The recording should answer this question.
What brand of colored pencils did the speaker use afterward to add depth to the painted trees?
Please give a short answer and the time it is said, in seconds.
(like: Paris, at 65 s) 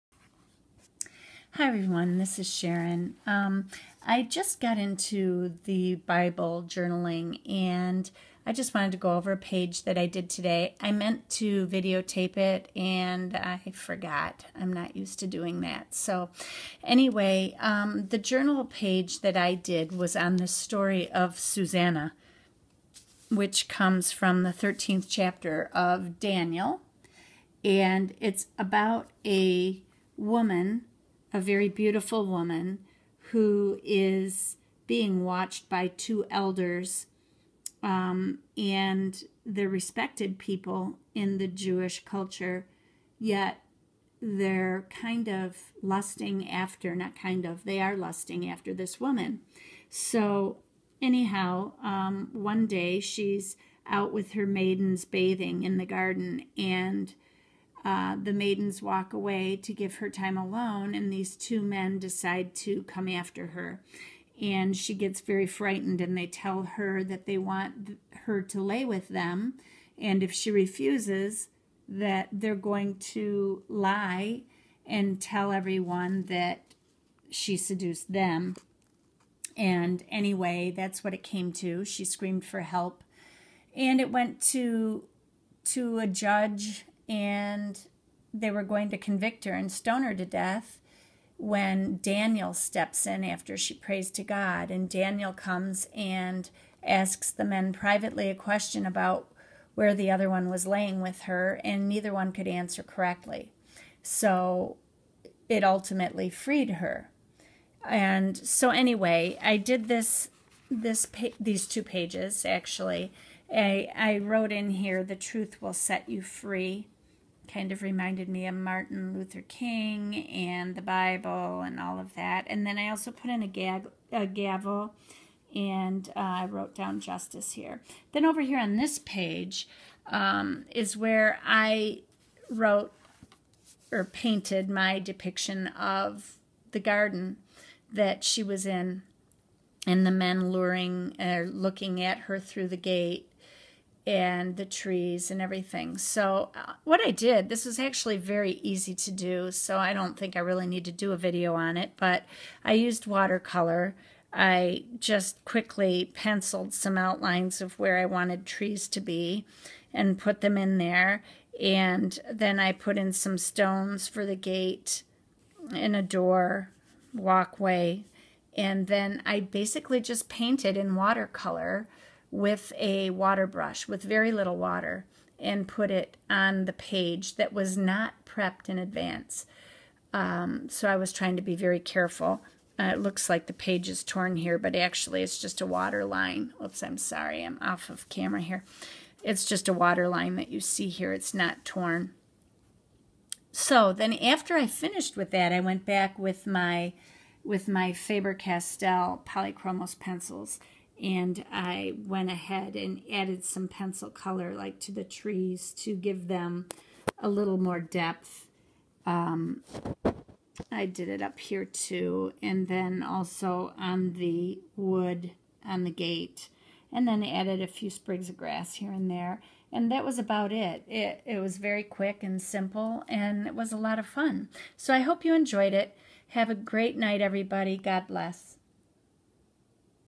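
Faber-Castell Polychromos, at 197 s.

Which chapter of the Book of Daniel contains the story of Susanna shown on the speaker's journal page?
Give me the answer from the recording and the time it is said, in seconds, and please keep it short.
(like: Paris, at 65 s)
13th, at 24 s.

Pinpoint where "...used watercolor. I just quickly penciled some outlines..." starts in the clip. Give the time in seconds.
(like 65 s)
152 s.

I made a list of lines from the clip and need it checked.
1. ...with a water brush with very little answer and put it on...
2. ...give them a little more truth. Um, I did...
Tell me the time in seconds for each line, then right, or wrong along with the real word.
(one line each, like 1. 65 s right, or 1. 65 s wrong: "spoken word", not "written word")
1. 172 s wrong: "water", not "answer"
2. 205 s wrong: "depth", not "truth".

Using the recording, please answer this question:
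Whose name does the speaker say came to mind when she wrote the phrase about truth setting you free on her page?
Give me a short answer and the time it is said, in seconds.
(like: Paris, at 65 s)
Martin Luther King, at 118 s.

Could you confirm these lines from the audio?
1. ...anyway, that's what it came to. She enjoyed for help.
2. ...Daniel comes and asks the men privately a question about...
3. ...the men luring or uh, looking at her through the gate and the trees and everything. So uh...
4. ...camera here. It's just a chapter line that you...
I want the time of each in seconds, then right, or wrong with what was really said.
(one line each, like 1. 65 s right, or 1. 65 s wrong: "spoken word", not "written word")
1. 80 s wrong: "screamed", not "enjoyed"
2. 94 s right
3. 140 s right
4. 188 s wrong: "water", not "chapter".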